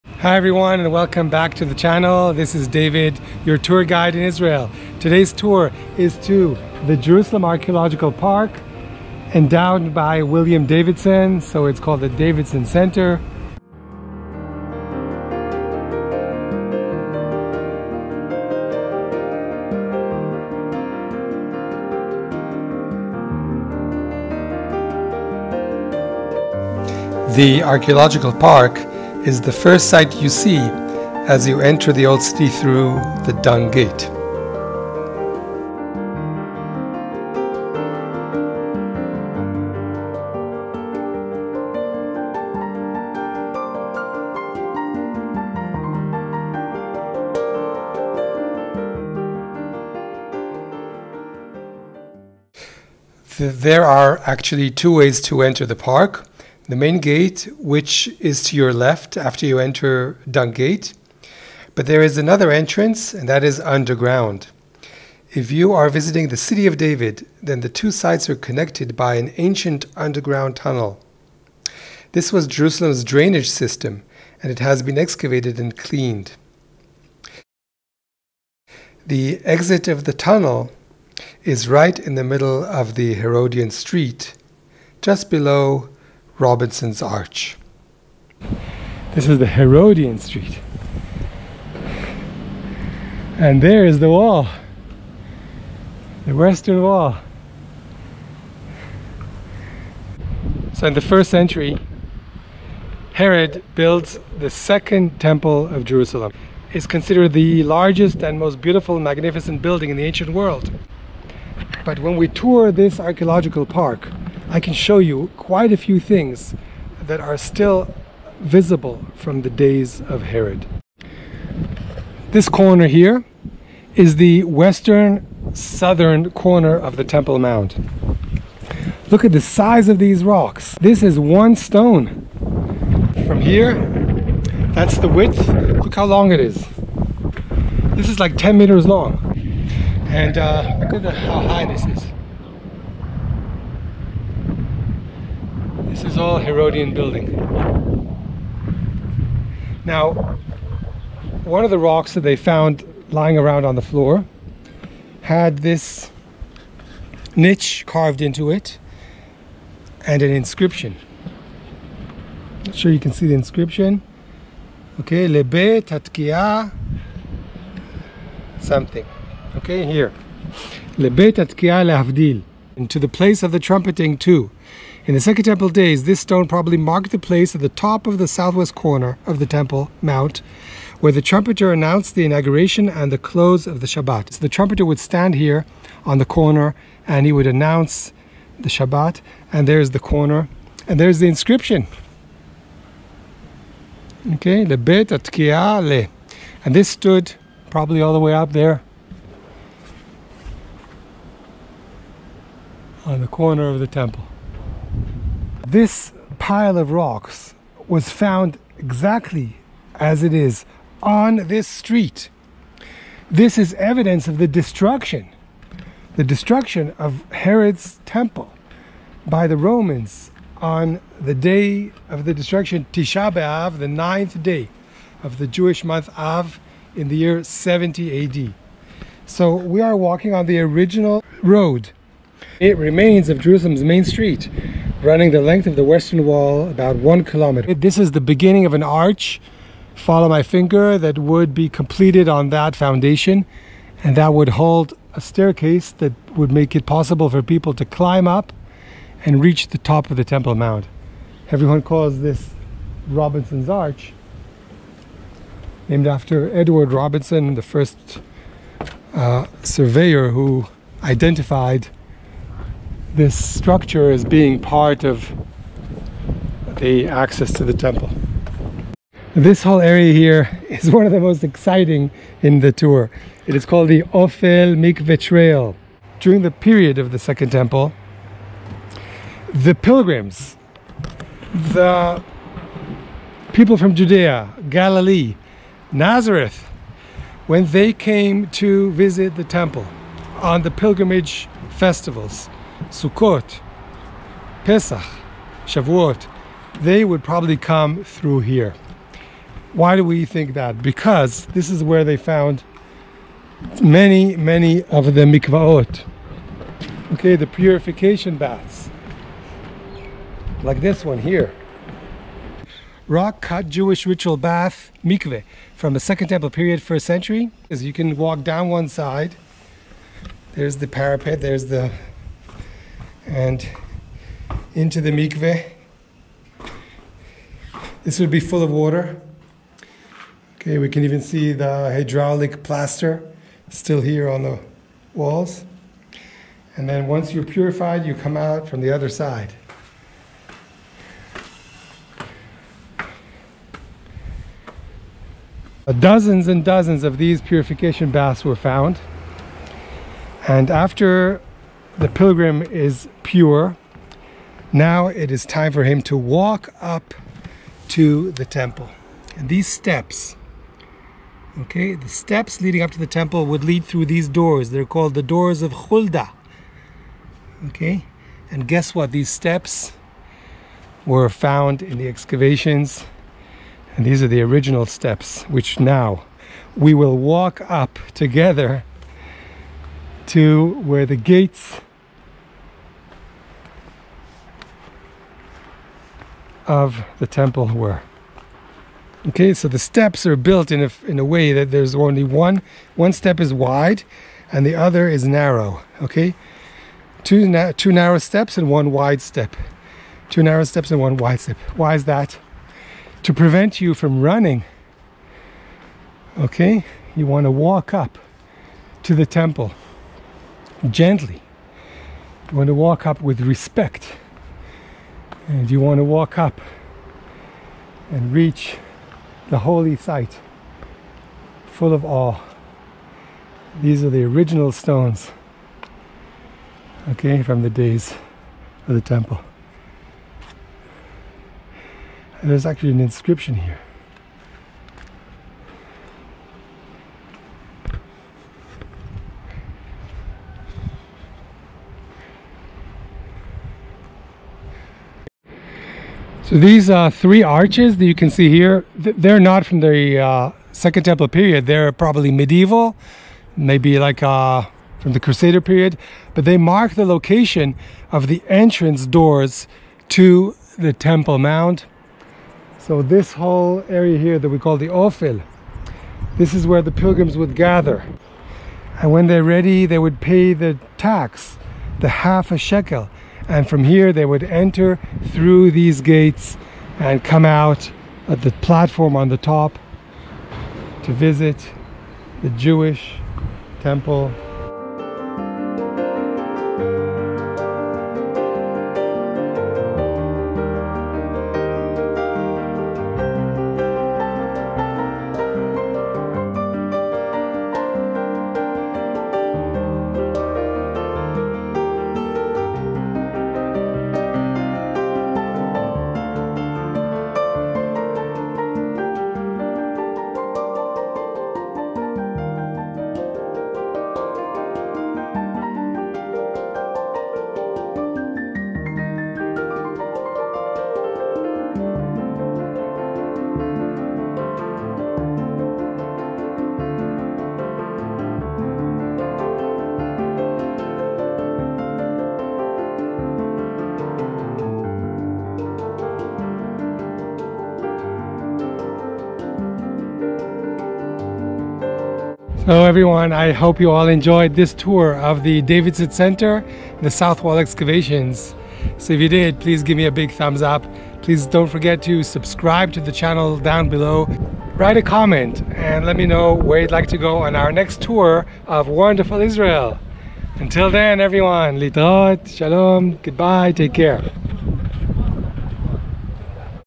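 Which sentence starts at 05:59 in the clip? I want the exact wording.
And these steps, okay, the steps leading up to the temple would lead through these doors.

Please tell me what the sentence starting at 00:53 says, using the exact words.
There are actually two ways to enter the park the main gate, which is to your left after you enter Dung Gate.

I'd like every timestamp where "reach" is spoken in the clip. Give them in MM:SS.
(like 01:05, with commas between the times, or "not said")
04:09, 06:58.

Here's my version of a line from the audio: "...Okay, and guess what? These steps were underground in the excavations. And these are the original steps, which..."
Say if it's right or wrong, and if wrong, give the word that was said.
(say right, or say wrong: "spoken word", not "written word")
wrong: "found", not "underground".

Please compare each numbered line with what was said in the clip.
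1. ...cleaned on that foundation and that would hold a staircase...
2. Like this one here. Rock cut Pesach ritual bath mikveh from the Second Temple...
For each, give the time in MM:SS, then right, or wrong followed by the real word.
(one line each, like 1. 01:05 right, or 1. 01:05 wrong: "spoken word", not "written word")
1. 04:01 wrong: "completed", not "cleaned"
2. 05:10 wrong: "Jewish", not "Pesach".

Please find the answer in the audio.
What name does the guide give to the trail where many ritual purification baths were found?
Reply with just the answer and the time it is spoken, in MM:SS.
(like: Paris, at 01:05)
Ofel Mikveh Trail, at 04:34.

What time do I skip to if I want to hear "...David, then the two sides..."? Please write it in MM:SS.
01:06.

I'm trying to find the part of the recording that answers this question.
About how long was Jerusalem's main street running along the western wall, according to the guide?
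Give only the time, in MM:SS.
03:56.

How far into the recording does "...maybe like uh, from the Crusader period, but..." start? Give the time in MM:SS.
07:33.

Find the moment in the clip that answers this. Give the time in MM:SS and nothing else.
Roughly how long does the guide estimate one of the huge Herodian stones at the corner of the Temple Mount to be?
02:18.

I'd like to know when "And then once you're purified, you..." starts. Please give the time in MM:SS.
05:36.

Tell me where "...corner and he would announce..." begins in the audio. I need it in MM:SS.
03:06.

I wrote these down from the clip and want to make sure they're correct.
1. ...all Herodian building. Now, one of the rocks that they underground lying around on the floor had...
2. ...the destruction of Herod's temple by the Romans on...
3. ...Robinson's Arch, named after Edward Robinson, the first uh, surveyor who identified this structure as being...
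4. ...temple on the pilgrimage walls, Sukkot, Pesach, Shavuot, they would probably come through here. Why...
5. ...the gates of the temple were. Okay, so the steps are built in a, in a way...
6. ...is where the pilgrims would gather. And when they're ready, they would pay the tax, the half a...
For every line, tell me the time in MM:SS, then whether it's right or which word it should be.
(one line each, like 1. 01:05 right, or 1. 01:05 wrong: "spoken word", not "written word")
1. 02:26 wrong: "found", not "underground"
2. 03:36 right
3. 04:13 right
4. 04:49 wrong: "festivals", not "walls"
5. 06:21 right
6. 07:46 right.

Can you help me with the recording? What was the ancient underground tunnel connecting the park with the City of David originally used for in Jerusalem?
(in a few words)
drainage system.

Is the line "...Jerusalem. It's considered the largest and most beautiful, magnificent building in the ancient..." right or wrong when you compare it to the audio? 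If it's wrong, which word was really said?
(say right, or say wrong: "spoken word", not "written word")
right.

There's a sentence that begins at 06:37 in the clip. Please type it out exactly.
Two, na two narrow steps and one wide step.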